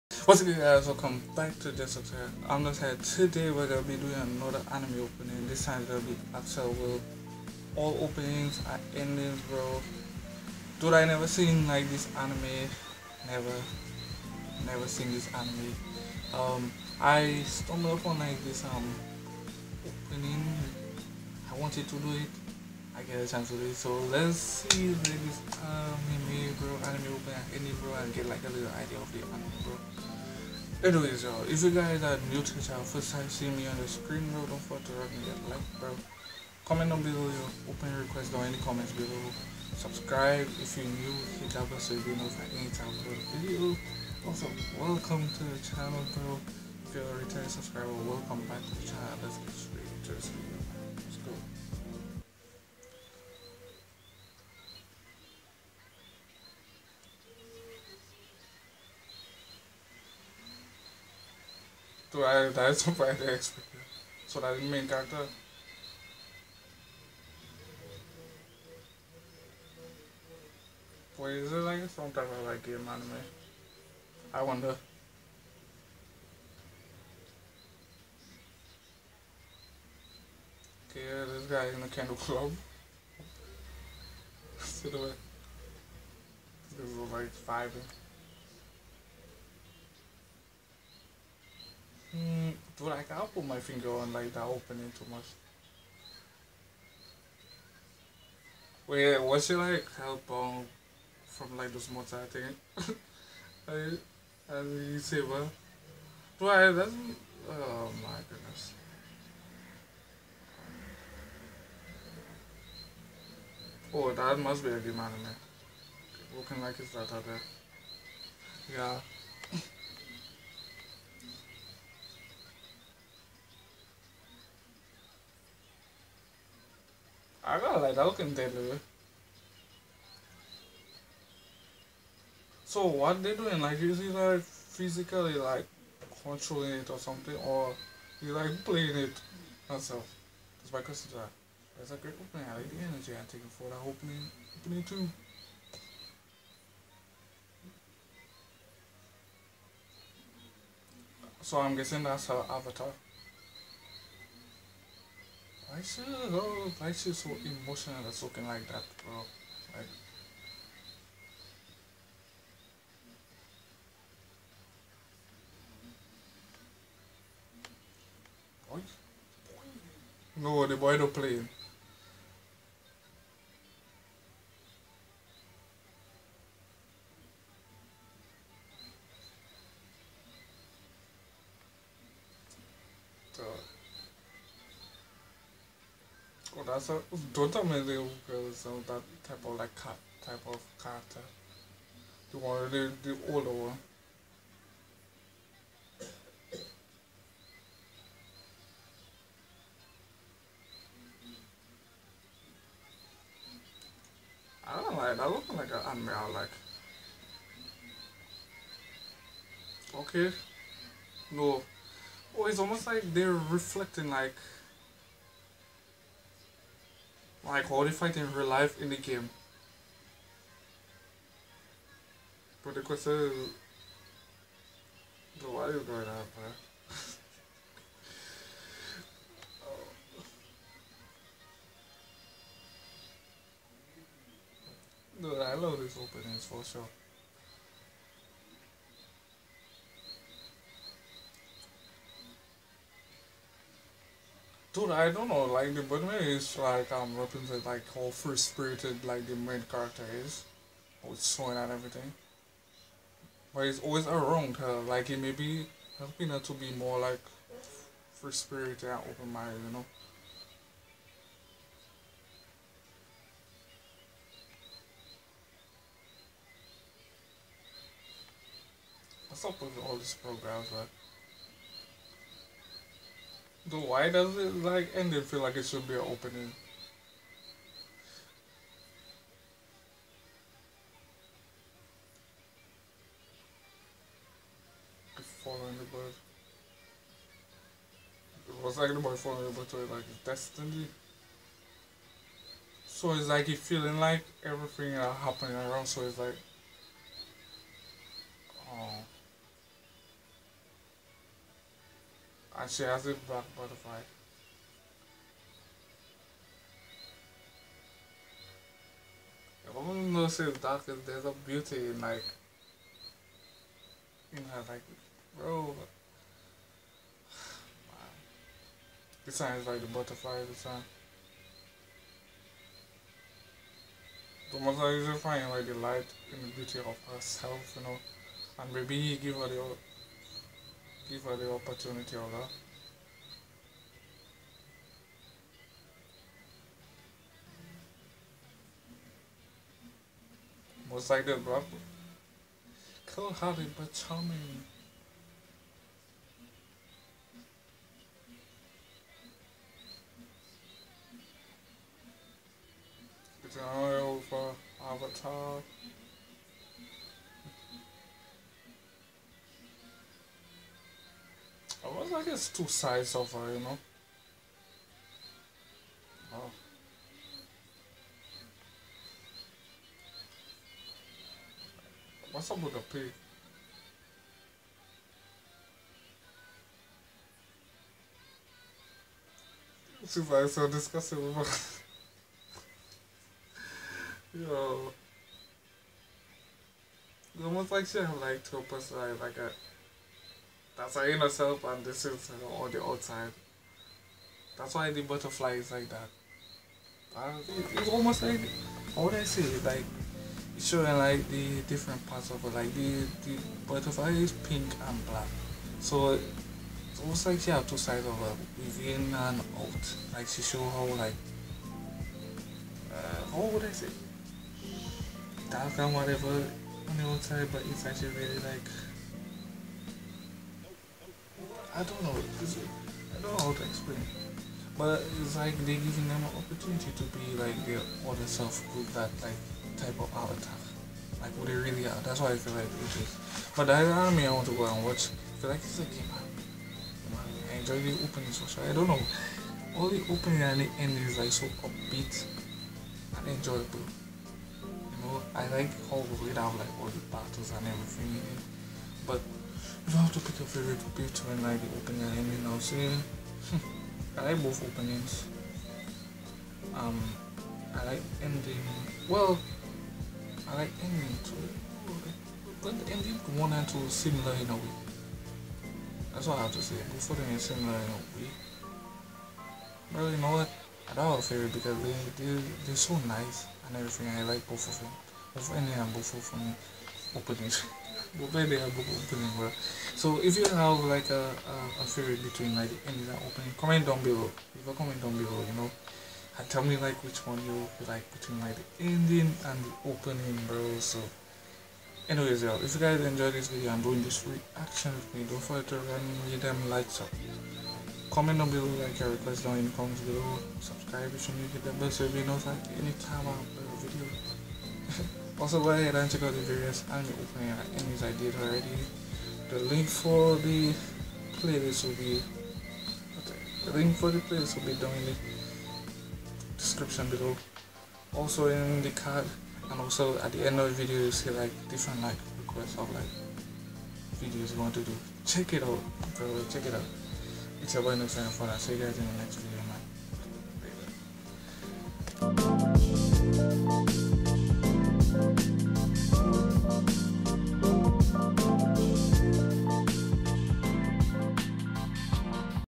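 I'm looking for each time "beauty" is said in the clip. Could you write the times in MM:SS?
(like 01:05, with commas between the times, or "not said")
05:11, 05:26.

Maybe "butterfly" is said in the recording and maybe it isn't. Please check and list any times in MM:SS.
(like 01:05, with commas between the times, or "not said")
05:19, 06:35, 06:43.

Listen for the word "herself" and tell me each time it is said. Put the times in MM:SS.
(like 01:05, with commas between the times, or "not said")
05:27.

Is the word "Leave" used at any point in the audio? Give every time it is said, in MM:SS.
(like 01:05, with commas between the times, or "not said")
08:04.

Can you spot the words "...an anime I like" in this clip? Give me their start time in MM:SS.
03:25.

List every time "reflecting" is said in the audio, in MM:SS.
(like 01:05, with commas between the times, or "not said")
03:33.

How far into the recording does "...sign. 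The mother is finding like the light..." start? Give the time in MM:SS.
05:20.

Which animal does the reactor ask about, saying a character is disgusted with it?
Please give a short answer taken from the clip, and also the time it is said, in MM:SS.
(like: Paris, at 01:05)
pig, at 06:12.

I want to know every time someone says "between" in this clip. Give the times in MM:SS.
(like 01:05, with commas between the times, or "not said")
08:02, 08:08.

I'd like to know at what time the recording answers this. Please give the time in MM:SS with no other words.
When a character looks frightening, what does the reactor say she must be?
01:54.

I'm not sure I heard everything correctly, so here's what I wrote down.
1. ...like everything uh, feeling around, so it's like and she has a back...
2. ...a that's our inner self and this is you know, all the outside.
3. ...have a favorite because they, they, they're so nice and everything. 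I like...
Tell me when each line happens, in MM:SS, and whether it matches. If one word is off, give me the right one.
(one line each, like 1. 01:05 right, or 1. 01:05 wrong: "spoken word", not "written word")
1. 04:53 wrong: "happening", not "feeling"
2. 06:29 right
3. 07:51 right.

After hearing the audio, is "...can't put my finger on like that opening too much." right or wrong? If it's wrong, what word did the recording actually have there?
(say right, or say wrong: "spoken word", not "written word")
right.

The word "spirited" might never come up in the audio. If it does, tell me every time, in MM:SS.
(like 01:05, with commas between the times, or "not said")
04:08, 04:18.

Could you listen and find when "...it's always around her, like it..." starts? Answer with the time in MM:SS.
04:13.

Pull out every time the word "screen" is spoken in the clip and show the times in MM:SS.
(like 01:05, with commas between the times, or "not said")
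00:33.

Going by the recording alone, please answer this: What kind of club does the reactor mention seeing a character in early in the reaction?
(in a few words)
candle club.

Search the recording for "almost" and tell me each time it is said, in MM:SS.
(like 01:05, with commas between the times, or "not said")
03:32, 06:27, 06:37, 06:46.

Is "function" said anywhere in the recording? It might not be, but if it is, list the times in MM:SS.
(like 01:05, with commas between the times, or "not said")
not said.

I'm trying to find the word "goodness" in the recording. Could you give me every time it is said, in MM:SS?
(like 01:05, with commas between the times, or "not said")
01:48.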